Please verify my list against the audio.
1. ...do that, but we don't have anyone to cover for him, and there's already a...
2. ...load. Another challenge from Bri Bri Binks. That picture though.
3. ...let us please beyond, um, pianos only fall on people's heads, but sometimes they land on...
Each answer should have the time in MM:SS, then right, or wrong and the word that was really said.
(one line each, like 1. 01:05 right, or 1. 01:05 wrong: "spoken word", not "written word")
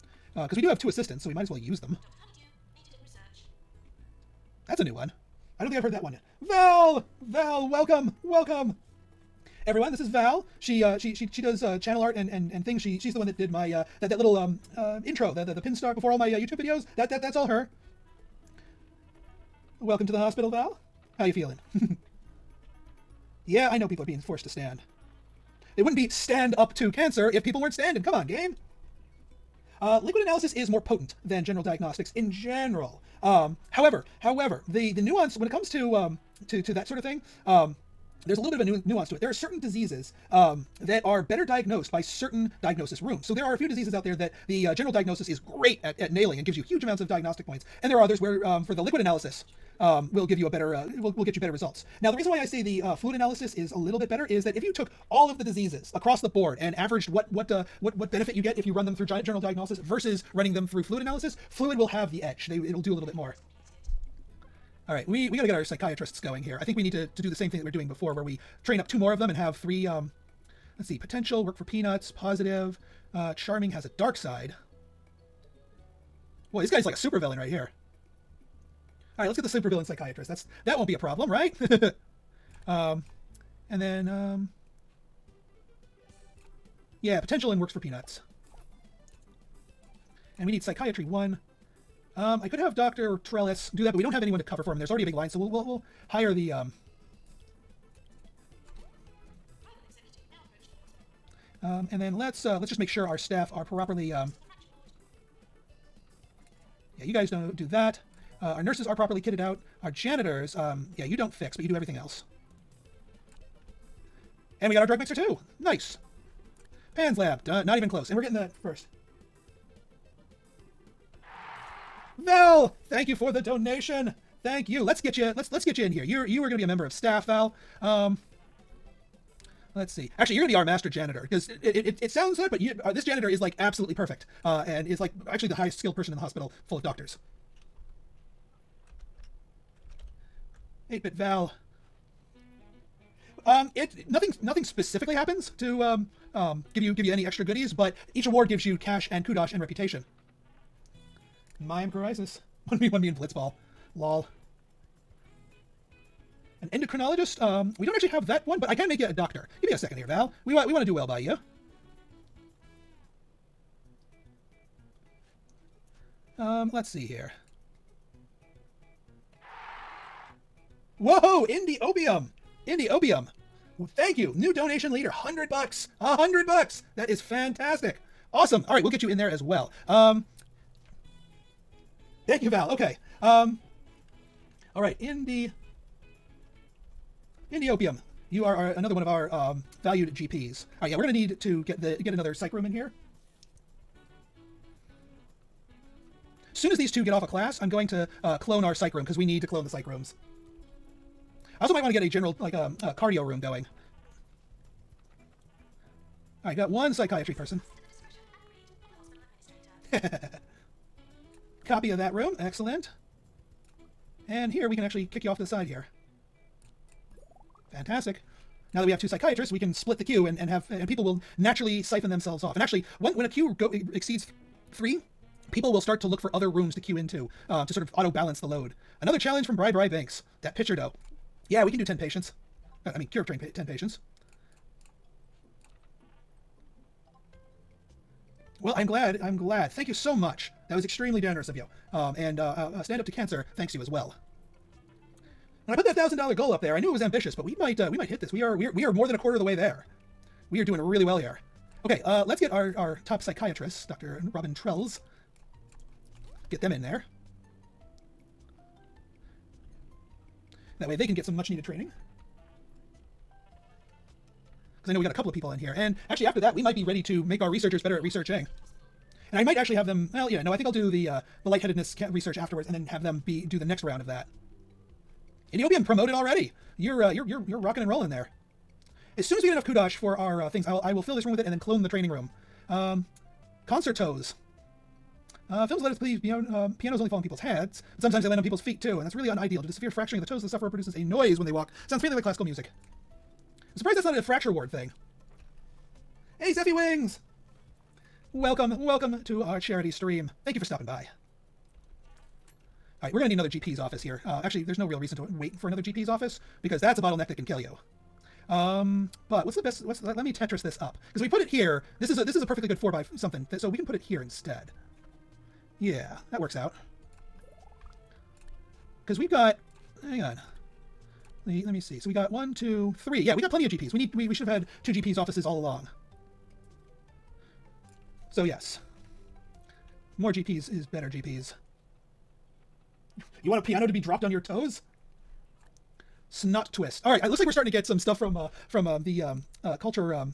1. 01:33 right
2. 03:48 right
3. 04:45 right.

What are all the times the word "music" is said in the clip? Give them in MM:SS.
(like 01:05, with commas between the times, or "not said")
04:52.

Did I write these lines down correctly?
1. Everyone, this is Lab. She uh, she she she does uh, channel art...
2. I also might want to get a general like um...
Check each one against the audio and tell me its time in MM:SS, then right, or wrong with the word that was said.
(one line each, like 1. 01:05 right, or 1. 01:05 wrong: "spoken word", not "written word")
1. 00:09 wrong: "Val", not "Lab"
2. 03:21 right.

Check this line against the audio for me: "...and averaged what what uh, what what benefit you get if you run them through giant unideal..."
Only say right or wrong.
wrong.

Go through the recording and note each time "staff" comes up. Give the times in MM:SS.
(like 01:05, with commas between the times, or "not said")
01:43, 02:06.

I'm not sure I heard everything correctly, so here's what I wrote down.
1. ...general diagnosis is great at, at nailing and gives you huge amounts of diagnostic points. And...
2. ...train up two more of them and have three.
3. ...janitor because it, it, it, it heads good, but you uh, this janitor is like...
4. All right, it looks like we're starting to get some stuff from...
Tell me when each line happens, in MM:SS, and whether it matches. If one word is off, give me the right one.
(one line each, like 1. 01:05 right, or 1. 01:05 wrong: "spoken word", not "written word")
1. 00:44 right
2. 01:08 right
3. 02:10 wrong: "sounds", not "heads"
4. 05:37 right.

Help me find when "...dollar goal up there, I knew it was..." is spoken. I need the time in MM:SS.
04:06.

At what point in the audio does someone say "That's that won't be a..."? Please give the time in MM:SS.
01:20.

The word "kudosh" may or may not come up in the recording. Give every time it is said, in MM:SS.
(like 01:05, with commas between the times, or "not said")
02:29, 04:39.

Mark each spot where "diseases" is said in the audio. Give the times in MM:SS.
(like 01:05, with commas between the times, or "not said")
00:39, 00:43, 00:55.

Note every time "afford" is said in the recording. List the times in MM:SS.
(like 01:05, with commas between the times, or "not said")
not said.